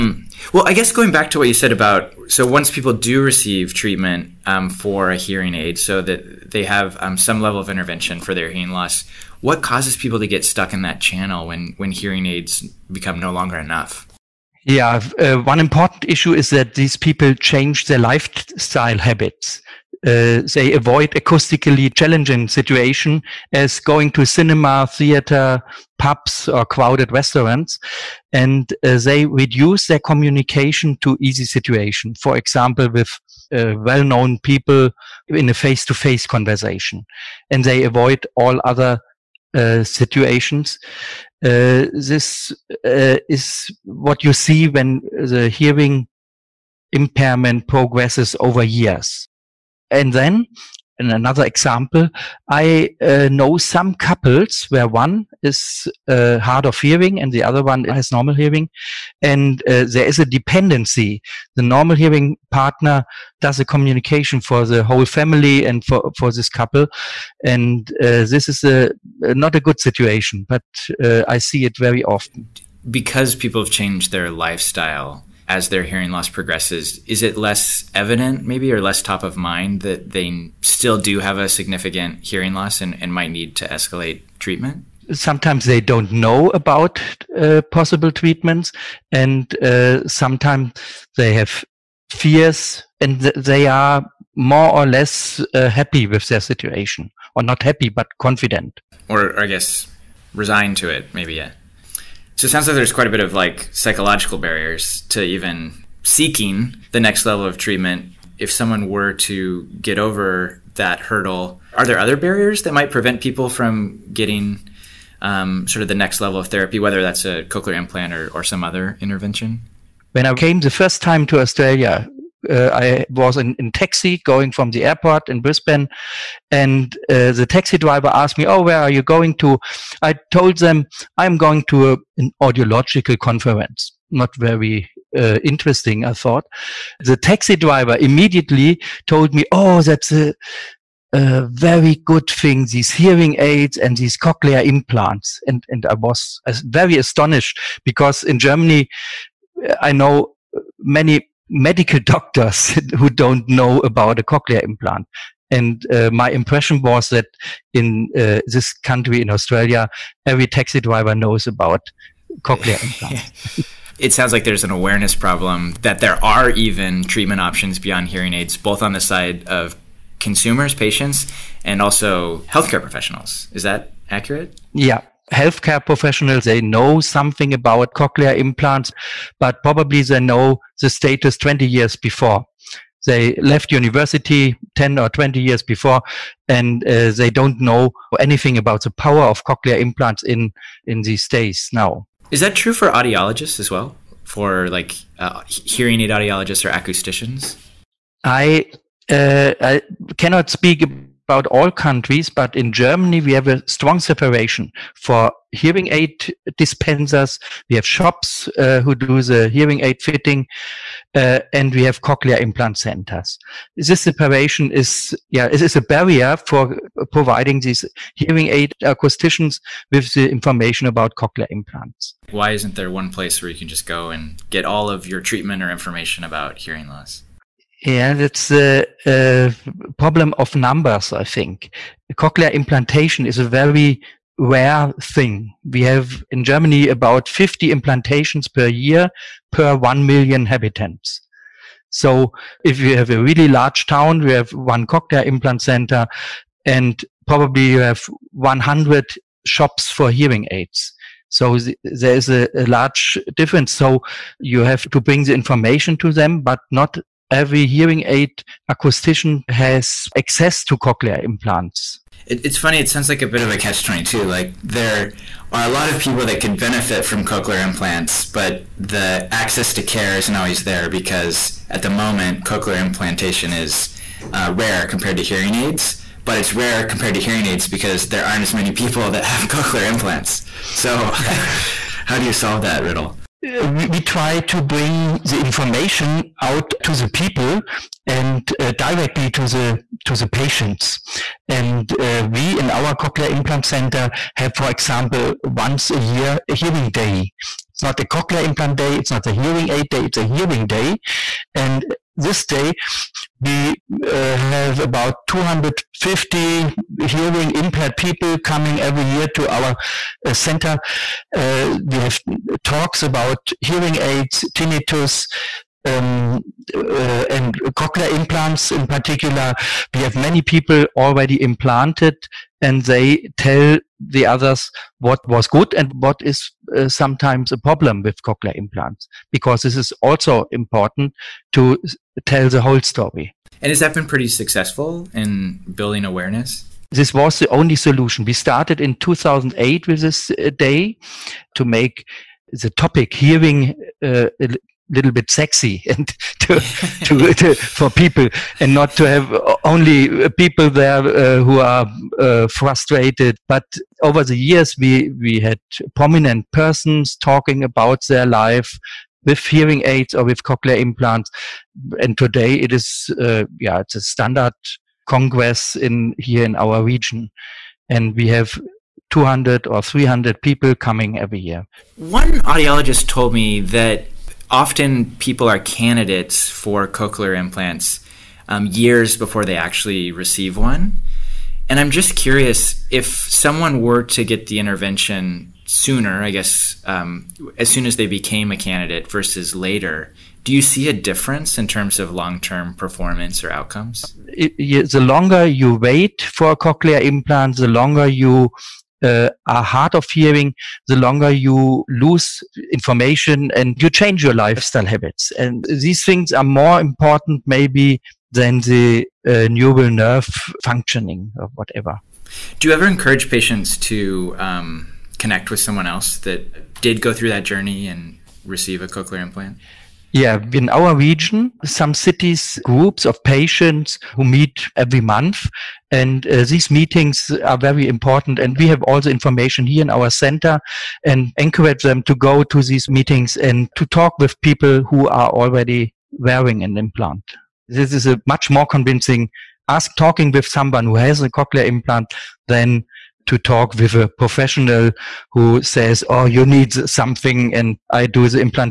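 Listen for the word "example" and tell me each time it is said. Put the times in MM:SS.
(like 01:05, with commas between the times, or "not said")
00:32, 00:51, 04:54.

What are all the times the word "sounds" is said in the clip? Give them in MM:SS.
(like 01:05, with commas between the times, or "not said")
01:42, 02:44, 04:22.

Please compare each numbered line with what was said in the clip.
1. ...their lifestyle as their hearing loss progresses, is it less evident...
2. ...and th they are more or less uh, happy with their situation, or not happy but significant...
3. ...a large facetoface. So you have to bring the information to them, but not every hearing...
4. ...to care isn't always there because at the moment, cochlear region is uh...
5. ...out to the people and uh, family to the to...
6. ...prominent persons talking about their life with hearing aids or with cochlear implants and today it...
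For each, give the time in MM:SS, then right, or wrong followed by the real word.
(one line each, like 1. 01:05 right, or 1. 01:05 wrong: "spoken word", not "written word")
1. 01:14 right
2. 01:33 wrong: "confident", not "significant"
3. 04:12 wrong: "difference", not "facetoface"
4. 04:29 wrong: "implantation", not "region"
5. 04:46 wrong: "directly", not "family"
6. 05:55 right.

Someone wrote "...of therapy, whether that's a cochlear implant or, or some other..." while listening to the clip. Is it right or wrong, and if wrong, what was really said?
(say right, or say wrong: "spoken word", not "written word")
right.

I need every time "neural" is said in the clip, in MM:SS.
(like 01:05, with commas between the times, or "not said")
06:49.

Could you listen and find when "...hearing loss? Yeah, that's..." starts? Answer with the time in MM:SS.
03:46.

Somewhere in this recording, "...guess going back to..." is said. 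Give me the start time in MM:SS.
00:00.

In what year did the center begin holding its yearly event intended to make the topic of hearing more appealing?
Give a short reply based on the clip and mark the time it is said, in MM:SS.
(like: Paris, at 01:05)
2008, at 05:38.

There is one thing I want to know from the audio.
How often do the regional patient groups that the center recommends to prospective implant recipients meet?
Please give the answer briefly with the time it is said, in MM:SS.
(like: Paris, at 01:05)
every month, at 07:04.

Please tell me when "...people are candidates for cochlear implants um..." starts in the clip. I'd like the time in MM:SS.
06:15.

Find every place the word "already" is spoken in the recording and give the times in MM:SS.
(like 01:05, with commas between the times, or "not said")
05:20, 07:15.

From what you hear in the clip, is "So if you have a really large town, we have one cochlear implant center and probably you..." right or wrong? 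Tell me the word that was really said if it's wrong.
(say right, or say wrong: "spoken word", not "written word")
right.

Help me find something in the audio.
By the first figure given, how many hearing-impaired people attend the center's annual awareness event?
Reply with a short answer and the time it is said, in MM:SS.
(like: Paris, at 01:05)
250, at 05:05.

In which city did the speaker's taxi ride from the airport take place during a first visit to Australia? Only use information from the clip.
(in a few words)
Brisbane.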